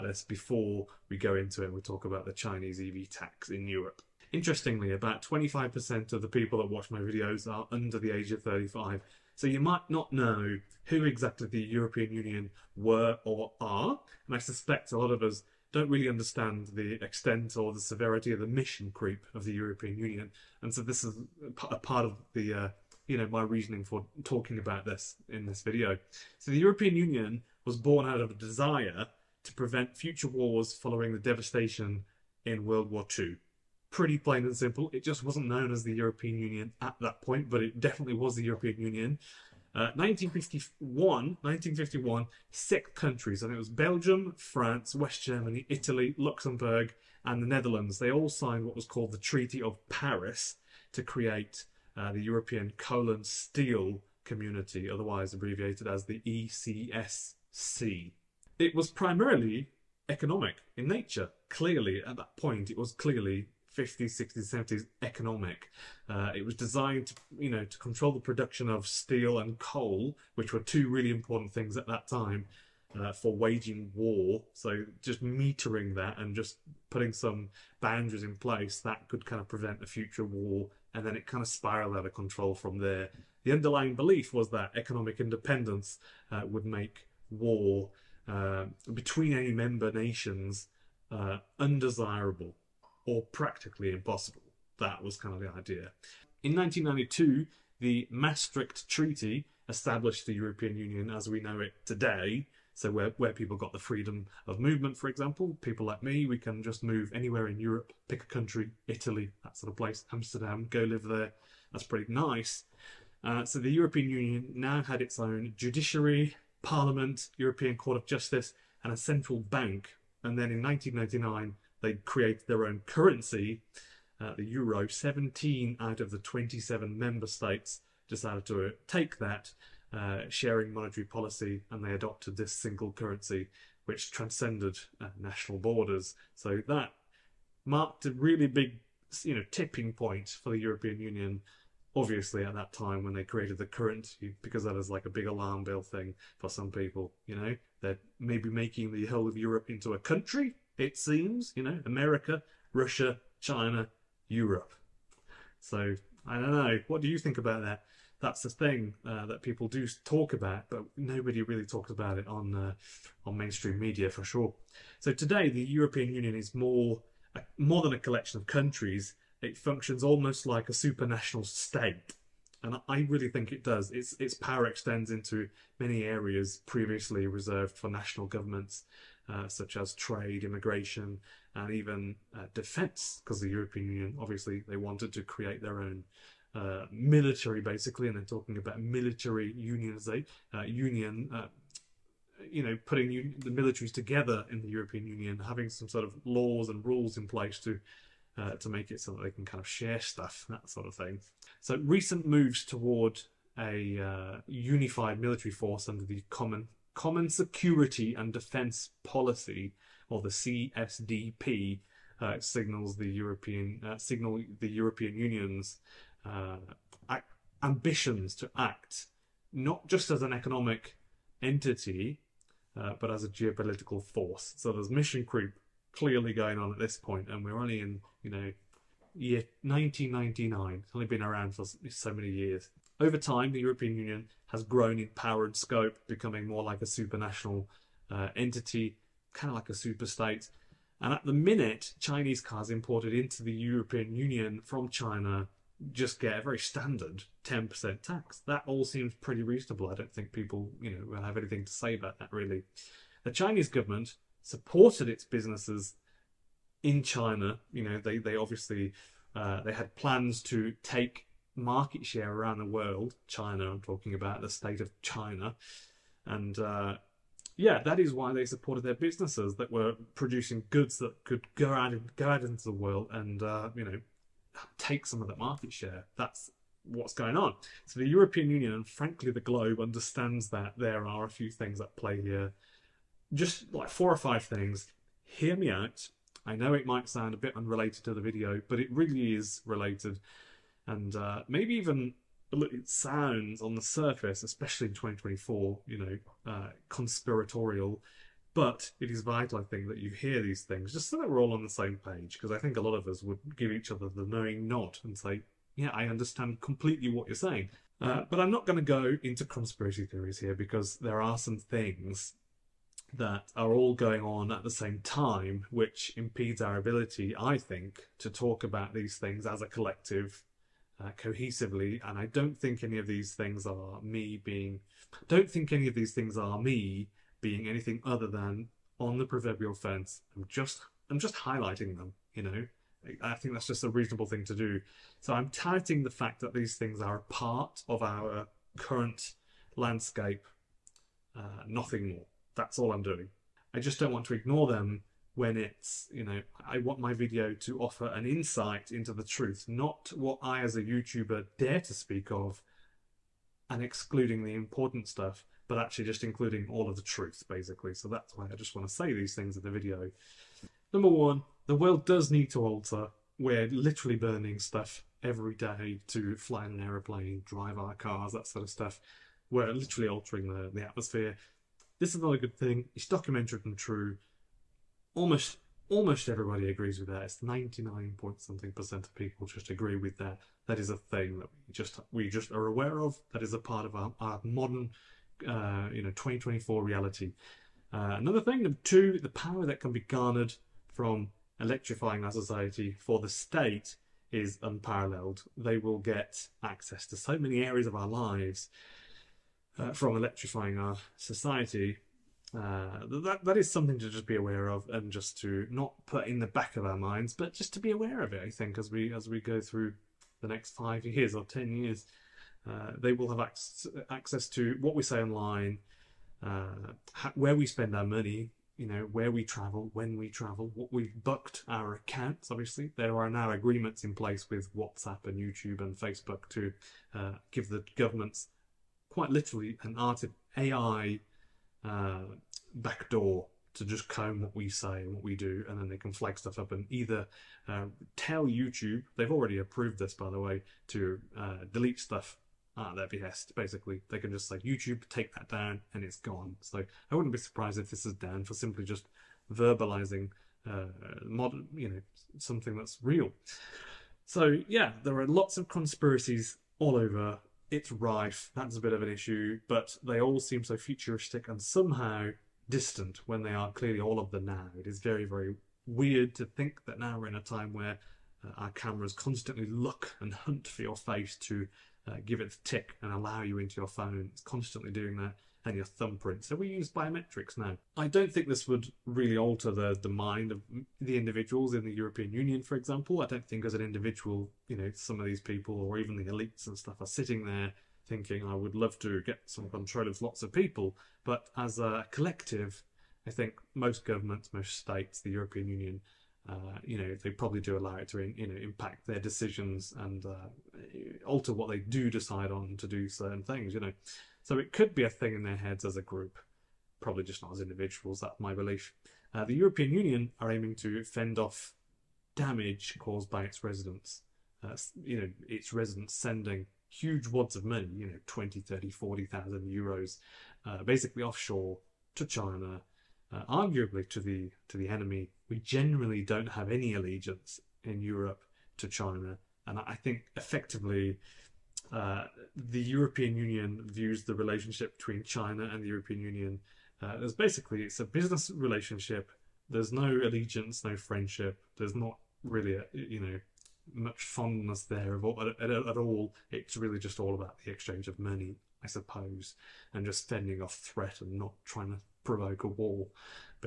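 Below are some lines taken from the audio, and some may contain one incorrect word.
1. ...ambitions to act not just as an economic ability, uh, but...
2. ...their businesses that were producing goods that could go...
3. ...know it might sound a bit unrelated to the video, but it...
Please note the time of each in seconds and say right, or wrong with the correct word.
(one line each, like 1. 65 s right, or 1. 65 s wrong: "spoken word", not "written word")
1. 217 s wrong: "entity", not "ability"
2. 268 s right
3. 286 s right.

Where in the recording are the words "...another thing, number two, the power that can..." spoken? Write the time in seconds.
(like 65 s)
388 s.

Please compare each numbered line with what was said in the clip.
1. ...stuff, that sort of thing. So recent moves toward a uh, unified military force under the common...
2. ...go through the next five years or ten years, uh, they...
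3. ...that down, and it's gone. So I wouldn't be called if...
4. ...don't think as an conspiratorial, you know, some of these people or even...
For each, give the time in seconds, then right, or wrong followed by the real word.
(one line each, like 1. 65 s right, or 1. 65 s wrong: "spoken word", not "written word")
1. 200 s right
2. 409 s right
3. 445 s wrong: "surprised", not "called"
4. 483 s wrong: "individual", not "conspiratorial".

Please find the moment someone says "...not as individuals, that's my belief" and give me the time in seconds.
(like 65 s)
507 s.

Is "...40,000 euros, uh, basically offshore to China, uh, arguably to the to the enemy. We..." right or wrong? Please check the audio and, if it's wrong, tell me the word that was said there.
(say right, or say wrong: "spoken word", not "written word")
right.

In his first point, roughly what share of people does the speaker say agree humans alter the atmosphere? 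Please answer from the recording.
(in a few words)
99%.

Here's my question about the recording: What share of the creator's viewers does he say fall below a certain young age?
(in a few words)
25%.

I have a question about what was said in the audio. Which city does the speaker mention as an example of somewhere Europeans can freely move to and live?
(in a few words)
Amsterdam.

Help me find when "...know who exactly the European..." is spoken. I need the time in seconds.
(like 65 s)
10 s.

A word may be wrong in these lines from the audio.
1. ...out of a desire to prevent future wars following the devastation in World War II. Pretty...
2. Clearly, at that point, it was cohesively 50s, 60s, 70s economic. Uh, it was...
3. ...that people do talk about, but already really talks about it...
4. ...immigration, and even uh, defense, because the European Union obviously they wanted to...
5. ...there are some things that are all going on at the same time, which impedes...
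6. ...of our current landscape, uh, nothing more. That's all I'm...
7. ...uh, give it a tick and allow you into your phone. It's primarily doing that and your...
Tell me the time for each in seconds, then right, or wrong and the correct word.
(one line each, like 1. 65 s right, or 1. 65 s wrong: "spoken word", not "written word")
1. 28 s right
2. 61 s wrong: "clearly", not "cohesively"
3. 159 s wrong: "nobody", not "already"
4. 180 s right
5. 310 s right
6. 337 s right
7. 472 s wrong: "constantly", not "primarily".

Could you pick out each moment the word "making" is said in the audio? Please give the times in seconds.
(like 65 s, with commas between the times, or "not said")
148 s.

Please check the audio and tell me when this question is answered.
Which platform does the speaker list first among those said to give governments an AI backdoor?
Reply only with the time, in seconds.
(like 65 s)
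424 s.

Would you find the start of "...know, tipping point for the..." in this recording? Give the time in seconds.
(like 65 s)
139 s.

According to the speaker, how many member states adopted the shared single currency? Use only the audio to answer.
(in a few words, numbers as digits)
17.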